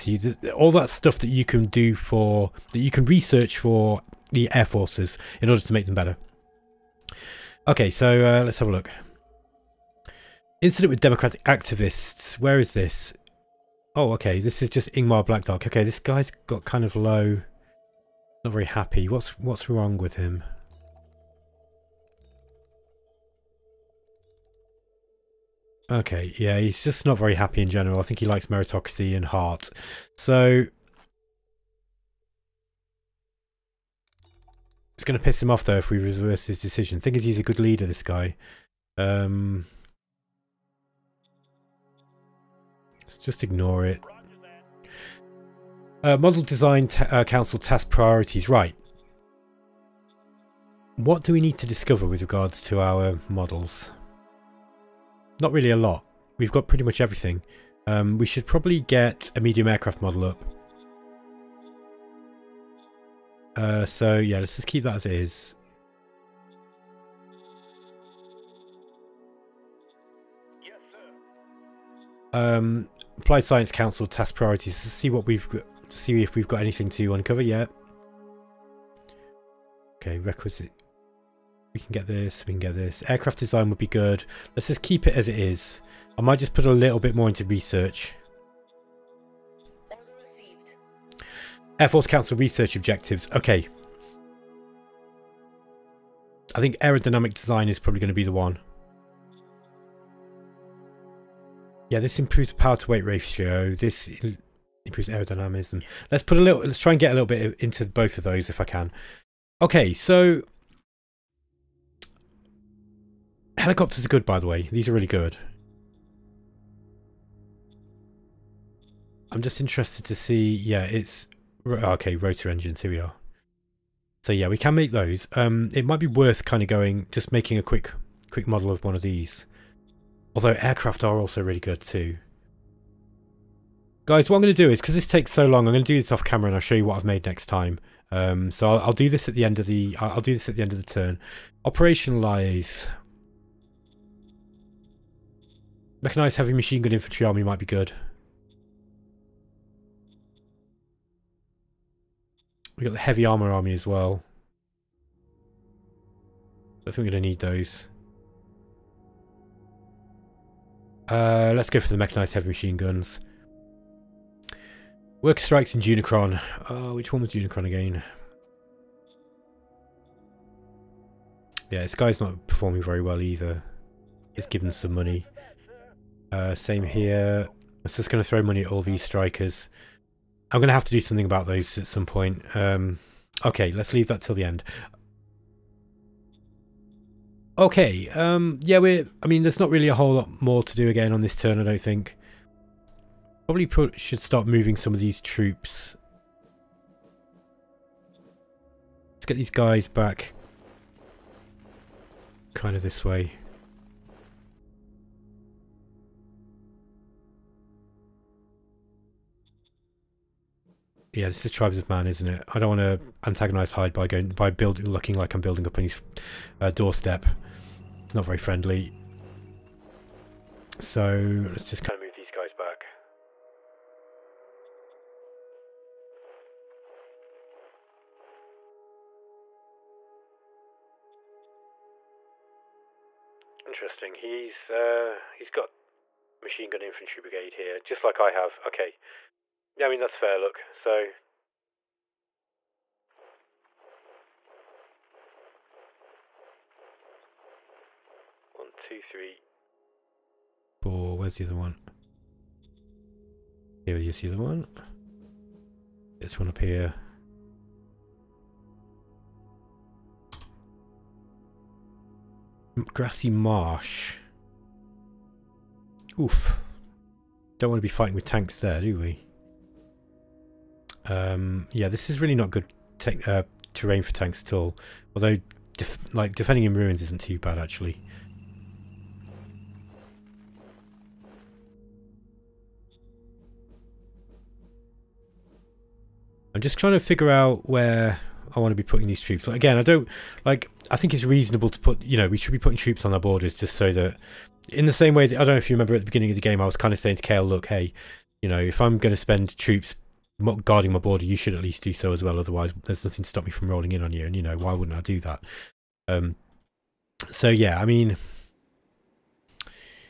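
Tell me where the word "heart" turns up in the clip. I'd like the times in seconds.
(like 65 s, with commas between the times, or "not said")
29 s.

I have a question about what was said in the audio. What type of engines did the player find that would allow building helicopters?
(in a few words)
Rotor engines.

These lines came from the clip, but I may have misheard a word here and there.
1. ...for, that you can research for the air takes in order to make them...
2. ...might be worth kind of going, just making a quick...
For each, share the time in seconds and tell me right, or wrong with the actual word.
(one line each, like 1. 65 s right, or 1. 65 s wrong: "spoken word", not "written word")
1. 1 s wrong: "forces", not "takes"
2. 125 s right.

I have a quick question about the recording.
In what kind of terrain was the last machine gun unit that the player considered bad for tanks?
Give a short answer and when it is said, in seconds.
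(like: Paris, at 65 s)
Grassy marsh, at 262 s.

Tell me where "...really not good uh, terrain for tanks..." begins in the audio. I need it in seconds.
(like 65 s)
272 s.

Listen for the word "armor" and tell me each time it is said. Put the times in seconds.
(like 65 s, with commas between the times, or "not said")
153 s.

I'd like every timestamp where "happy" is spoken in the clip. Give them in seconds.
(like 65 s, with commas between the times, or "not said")
18 s, 27 s.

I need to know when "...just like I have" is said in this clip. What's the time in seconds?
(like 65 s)
237 s.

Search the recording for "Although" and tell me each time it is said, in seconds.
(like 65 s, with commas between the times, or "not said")
130 s, 275 s.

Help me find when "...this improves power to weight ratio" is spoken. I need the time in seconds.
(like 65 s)
101 s.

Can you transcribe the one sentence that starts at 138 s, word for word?
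Um, so I'll, I'll, do this at the end of the, I'll do this at the end of the turn.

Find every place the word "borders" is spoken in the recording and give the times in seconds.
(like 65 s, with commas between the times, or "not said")
293 s, 300 s.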